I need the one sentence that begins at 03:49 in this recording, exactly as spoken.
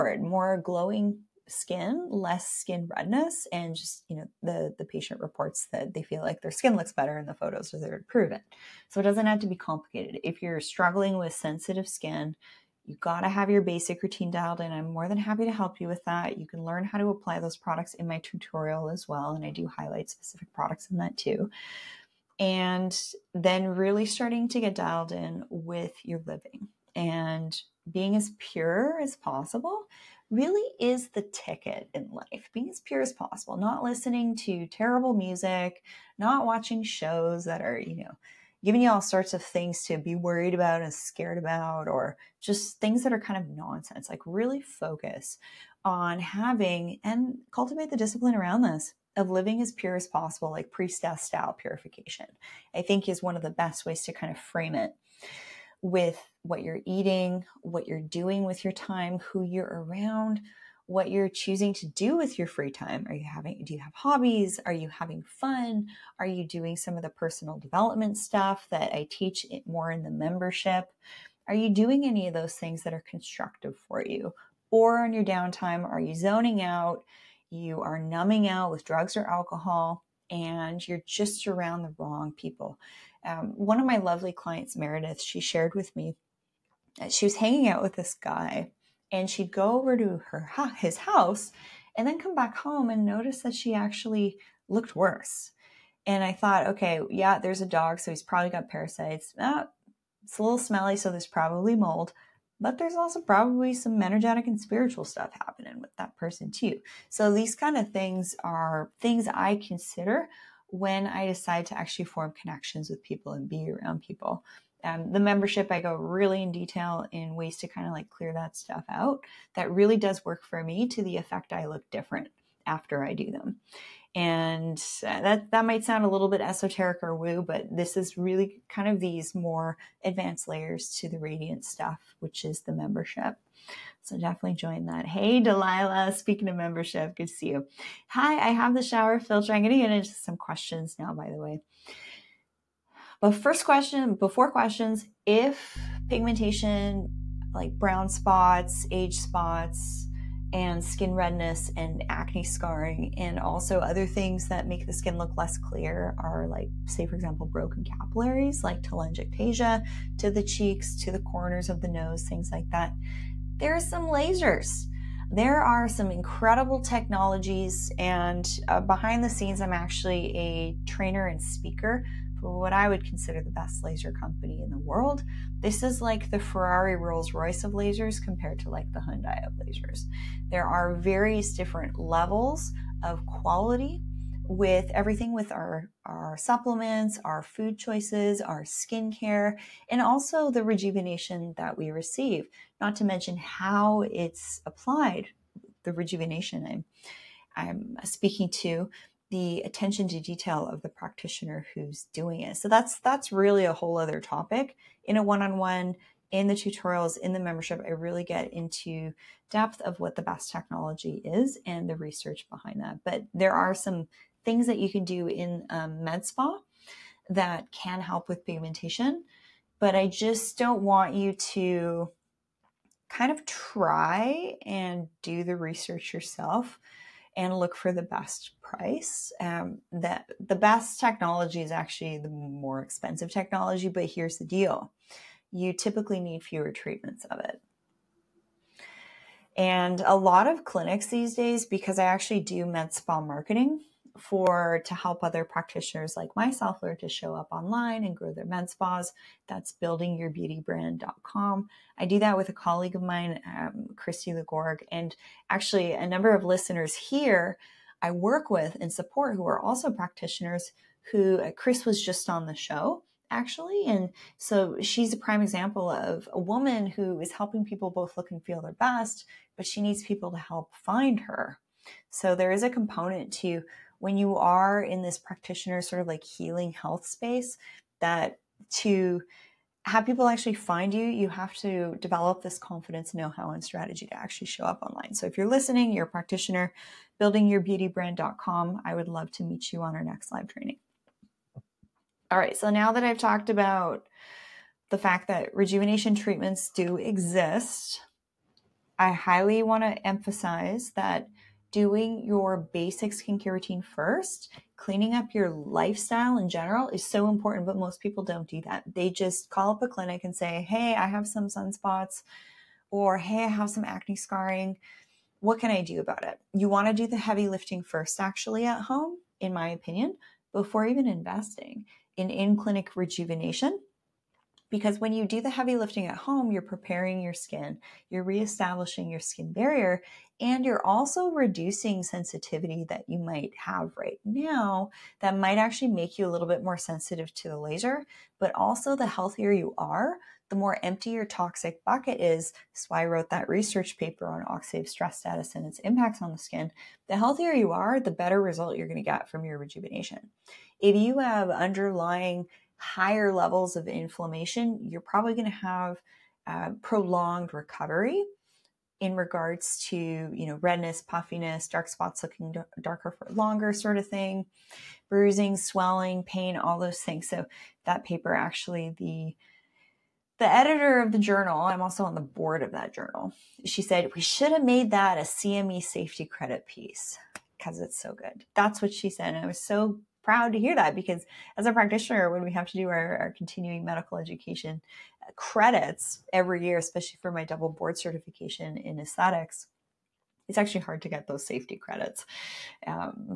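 Um, that the best technology is actually the more expensive technology, but here's the deal: you typically need fewer treatments of it.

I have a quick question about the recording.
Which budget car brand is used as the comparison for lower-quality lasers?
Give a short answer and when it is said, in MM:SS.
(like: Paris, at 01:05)
Hyundai, at 02:59.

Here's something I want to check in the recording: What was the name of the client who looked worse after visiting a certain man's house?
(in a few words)
Meredith.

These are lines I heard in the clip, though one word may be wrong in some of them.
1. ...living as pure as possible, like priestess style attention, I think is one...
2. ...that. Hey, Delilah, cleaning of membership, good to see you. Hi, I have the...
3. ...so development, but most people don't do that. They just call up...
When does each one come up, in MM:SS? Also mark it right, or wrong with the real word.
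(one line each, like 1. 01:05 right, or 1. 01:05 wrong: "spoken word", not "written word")
1. 00:49 wrong: "purification", not "attention"
2. 02:14 wrong: "speaking", not "cleaning"
3. 05:07 wrong: "important", not "development".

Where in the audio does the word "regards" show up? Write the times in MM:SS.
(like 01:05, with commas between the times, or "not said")
05:59.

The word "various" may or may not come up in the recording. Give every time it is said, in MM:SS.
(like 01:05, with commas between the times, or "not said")
03:00.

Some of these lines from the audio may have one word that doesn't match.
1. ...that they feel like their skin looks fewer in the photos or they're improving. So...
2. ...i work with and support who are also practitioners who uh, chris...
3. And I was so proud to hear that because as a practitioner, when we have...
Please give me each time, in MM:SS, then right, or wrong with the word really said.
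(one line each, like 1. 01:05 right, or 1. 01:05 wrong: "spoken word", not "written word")
1. 00:05 wrong: "better", not "fewer"
2. 04:18 right
3. 06:19 right.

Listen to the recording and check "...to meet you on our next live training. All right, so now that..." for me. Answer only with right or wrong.
right.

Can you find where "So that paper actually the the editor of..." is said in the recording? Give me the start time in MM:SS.
06:07.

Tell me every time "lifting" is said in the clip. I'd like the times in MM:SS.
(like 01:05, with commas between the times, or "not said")
05:17, 05:25.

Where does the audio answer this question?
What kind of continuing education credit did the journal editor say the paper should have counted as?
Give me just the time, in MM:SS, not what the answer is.
06:15.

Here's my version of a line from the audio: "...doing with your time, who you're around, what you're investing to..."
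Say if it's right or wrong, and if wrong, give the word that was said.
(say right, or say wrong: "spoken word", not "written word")
wrong: "choosing", not "investing".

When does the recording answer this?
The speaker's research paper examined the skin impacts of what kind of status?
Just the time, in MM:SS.
05:44.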